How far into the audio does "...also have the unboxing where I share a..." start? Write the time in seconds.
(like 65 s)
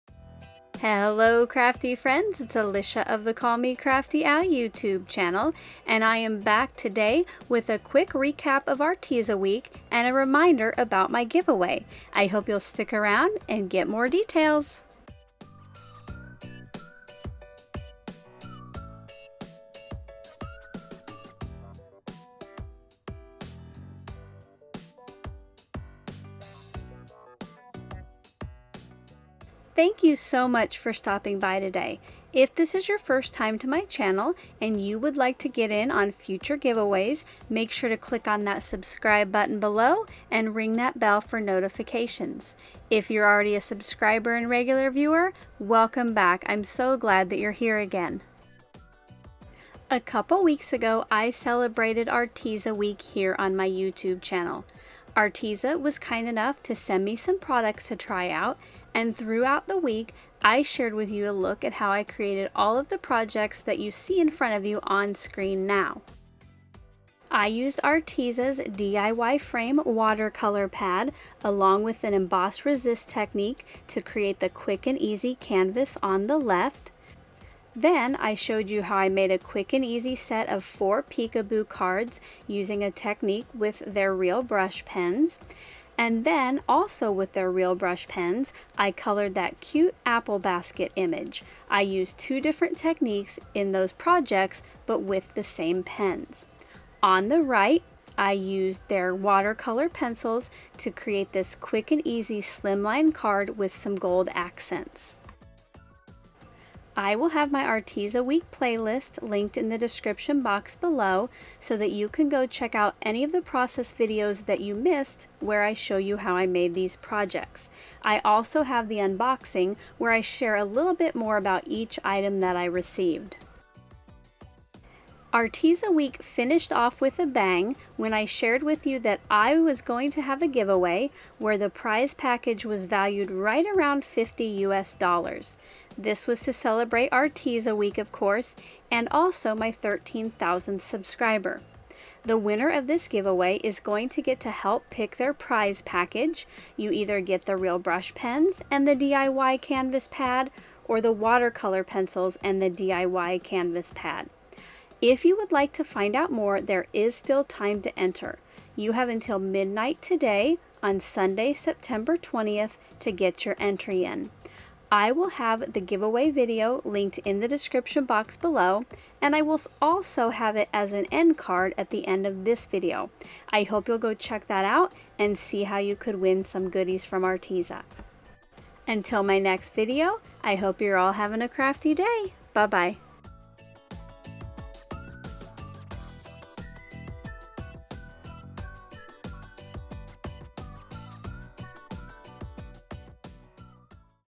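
118 s.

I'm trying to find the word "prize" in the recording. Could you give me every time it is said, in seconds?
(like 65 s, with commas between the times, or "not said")
131 s, 145 s.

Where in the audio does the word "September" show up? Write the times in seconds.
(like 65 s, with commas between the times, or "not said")
161 s.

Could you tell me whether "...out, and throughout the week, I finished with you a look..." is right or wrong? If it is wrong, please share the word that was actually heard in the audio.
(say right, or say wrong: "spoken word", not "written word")
wrong: "shared", not "finished".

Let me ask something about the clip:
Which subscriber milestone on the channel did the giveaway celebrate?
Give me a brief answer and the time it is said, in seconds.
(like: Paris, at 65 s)
13,000th, at 139 s.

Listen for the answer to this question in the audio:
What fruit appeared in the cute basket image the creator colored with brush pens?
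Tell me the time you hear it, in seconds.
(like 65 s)
90 s.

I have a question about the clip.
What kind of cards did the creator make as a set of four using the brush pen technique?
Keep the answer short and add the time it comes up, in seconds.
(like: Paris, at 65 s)
peekaboo cards, at 81 s.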